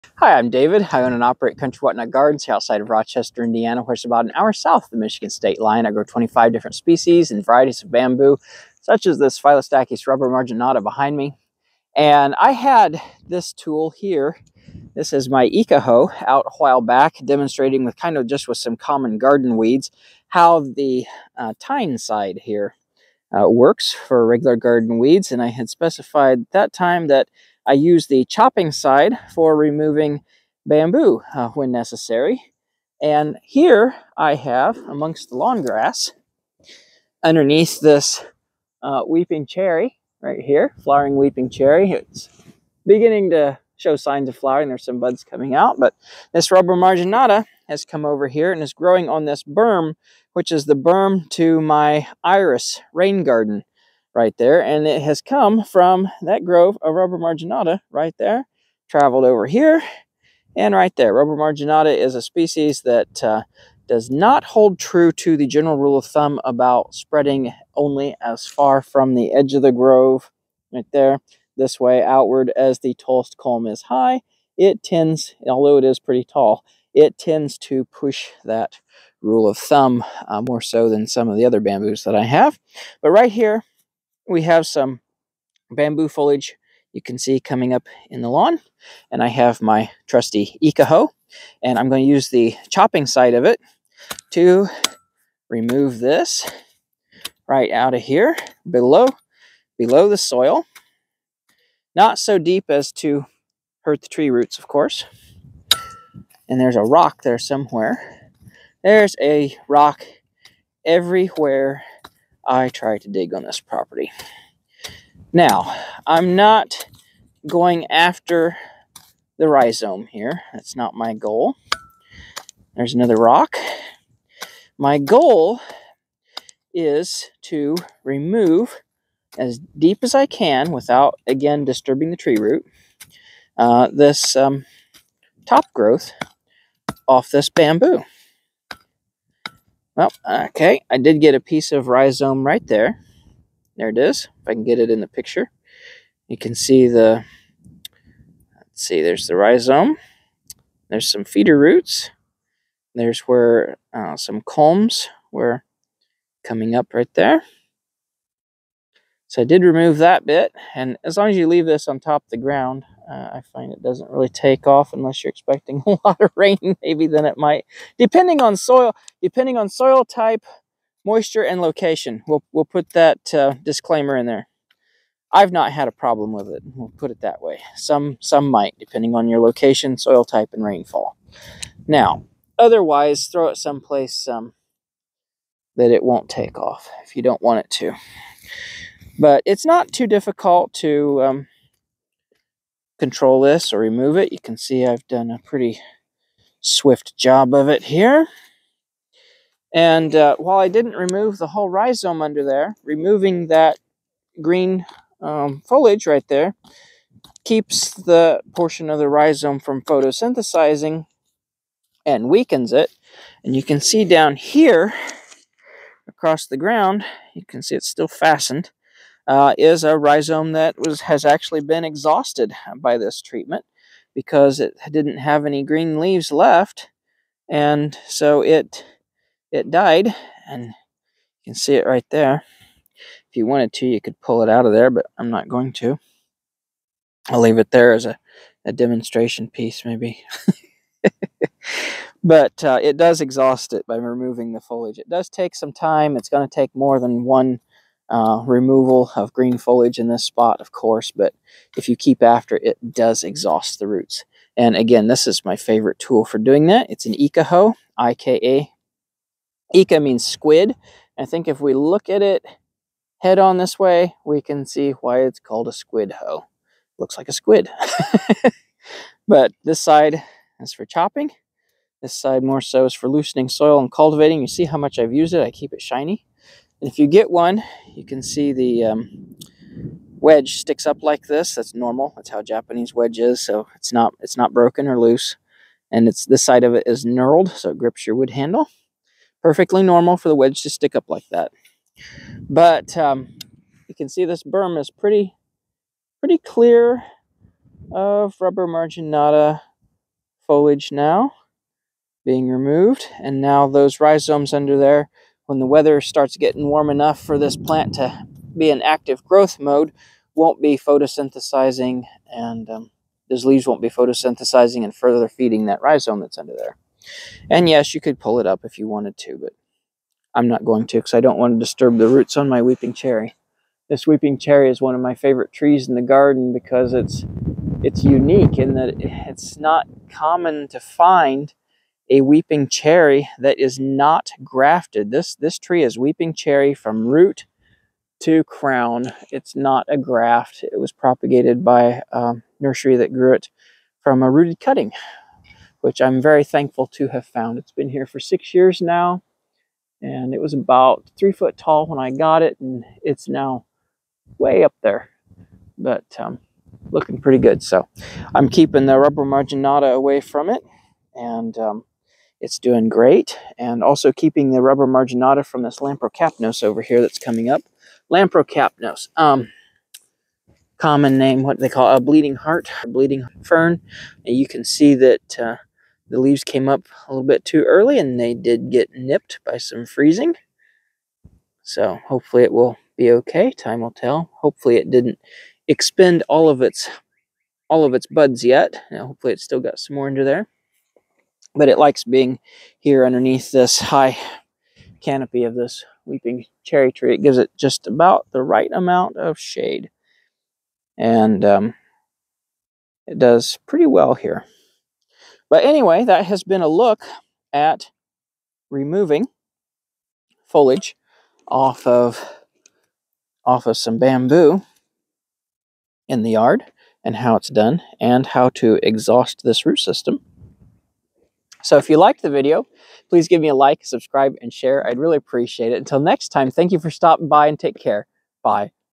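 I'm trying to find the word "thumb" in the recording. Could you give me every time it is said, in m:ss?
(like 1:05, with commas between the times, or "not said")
1:06, 1:19.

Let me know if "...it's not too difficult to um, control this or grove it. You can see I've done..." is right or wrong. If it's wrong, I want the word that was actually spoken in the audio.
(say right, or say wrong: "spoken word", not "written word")
wrong: "remove", not "grove".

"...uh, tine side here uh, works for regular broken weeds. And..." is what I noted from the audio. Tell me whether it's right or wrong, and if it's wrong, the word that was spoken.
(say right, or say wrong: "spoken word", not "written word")
wrong: "garden", not "broken".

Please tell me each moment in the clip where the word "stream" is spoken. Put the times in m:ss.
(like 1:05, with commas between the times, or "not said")
not said.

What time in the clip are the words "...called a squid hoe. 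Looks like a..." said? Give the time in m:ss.
4:25.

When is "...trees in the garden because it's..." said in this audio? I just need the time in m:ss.
5:25.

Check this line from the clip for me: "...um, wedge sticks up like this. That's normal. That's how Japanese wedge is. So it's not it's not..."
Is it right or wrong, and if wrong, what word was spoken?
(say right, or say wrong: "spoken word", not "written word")
right.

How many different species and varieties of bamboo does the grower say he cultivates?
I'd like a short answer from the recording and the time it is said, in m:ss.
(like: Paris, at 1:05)
25, at 0:06.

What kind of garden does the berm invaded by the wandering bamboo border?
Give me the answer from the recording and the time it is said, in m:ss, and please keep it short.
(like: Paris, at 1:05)
iris rain garden, at 0:52.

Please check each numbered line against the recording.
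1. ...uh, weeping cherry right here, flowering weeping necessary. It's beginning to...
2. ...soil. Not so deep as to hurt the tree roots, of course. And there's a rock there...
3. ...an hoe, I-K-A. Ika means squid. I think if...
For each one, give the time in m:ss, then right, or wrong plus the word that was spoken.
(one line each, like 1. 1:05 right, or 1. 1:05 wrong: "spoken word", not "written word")
1. 0:38 wrong: "cherry", not "necessary"
2. 1:40 right
3. 4:17 right.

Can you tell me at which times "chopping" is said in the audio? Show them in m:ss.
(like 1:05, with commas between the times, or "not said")
0:28, 1:32, 4:30.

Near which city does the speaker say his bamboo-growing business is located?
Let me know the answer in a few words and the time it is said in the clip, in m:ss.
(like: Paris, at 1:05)
Rochester, Indiana, at 0:02.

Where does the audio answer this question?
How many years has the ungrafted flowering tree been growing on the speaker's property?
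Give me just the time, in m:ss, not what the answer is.
5:48.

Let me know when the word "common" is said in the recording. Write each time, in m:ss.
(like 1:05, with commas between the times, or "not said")
0:18, 5:30, 6:10.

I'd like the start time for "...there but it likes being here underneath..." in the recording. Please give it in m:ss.
6:30.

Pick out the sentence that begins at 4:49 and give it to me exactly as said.
Perfectly normal for the wedge to stick up like that.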